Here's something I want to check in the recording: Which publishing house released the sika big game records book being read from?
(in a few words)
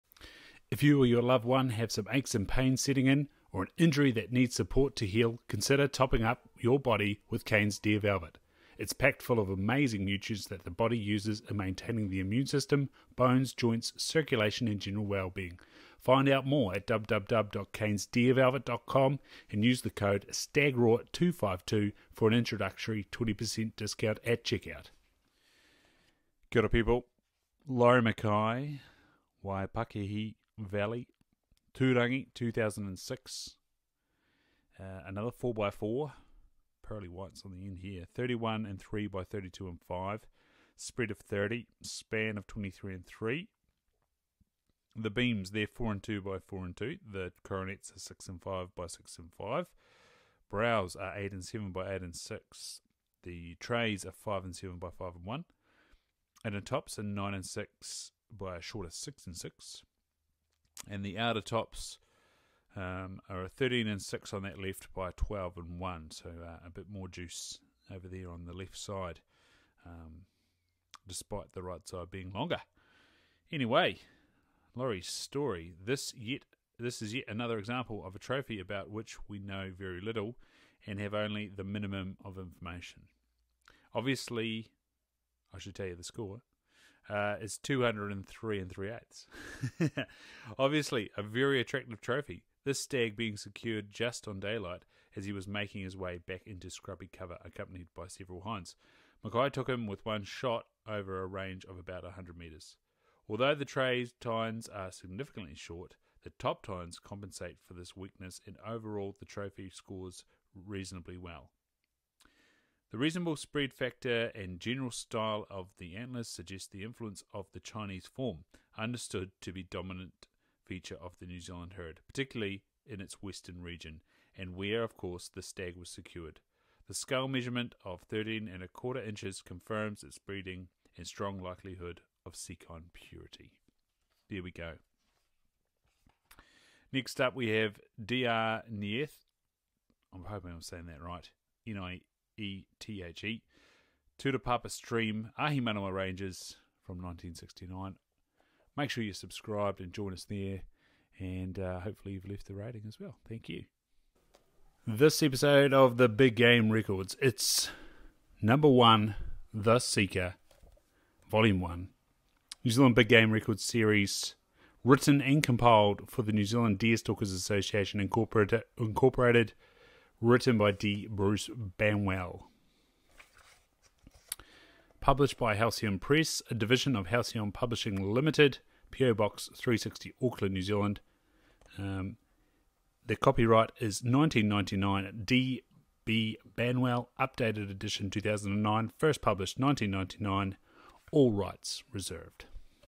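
Halcyon Press.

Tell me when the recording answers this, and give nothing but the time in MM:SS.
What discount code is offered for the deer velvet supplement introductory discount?
00:20.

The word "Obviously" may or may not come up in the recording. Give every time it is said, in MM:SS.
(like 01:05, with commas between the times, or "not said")
01:23, 01:30.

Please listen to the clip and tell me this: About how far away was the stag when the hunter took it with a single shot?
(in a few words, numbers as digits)
100 metres.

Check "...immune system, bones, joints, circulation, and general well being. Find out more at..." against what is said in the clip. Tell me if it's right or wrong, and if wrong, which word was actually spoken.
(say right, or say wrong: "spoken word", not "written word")
right.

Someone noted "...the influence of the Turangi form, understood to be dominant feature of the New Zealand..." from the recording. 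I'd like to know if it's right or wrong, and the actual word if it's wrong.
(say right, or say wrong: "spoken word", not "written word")
wrong: "Chinese", not "Turangi".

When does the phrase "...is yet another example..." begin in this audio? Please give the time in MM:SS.
01:17.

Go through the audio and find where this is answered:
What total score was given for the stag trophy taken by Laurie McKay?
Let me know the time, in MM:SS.
01:27.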